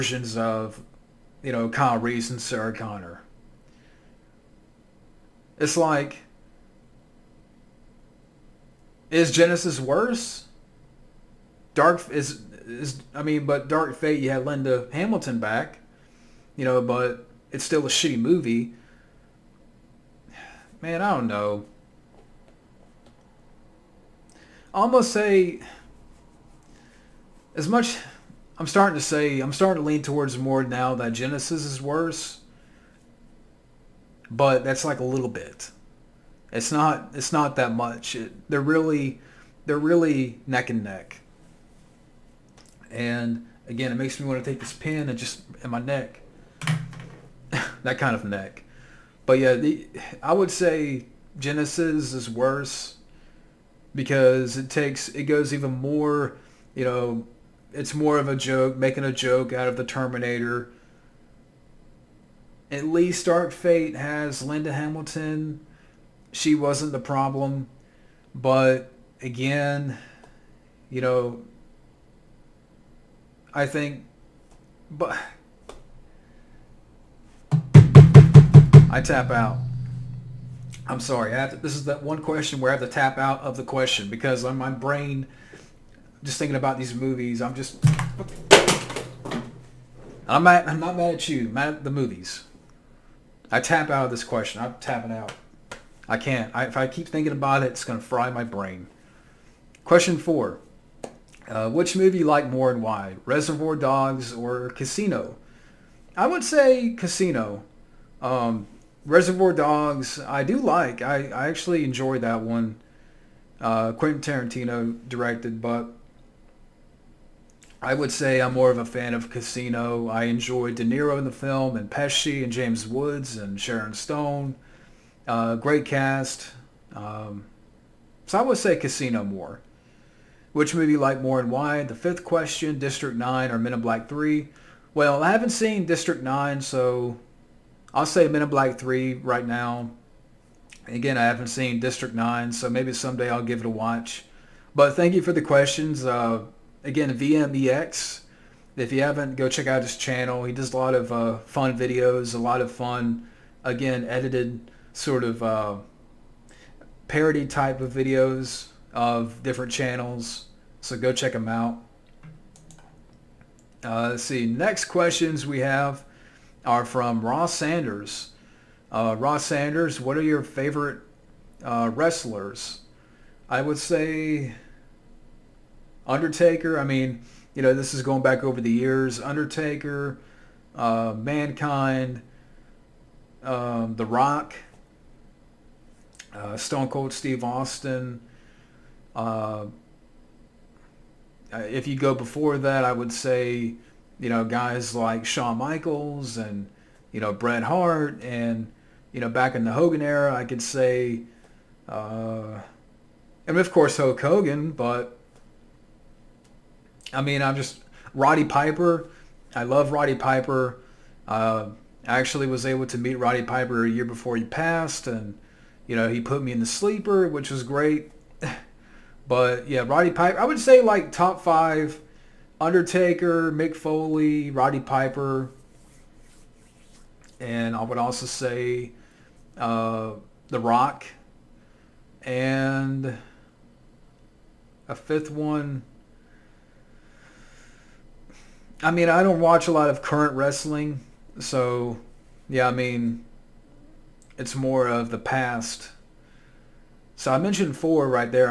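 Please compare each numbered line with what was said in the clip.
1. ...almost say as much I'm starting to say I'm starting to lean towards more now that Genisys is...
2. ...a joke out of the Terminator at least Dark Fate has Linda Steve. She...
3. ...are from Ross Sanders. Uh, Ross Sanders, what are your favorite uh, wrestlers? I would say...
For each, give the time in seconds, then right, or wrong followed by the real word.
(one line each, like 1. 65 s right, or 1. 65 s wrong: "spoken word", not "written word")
1. 24 s right
2. 59 s wrong: "Hamilton", not "Steve"
3. 166 s right.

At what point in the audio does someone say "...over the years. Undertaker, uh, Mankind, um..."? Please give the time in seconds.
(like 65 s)
178 s.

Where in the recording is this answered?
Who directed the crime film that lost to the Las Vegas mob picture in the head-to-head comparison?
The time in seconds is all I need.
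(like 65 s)
113 s.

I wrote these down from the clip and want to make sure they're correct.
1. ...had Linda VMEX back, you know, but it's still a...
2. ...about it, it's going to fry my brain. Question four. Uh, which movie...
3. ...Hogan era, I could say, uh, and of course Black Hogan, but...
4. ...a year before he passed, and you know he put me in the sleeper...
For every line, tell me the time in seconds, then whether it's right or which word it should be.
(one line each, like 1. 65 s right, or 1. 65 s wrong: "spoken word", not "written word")
1. 14 s wrong: "Hamilton", not "VMEX"
2. 97 s right
3. 199 s wrong: "Hulk", not "Black"
4. 213 s right.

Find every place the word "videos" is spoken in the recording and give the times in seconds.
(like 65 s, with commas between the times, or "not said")
151 s, 157 s.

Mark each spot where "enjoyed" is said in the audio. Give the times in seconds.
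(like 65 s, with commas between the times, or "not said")
111 s, 120 s.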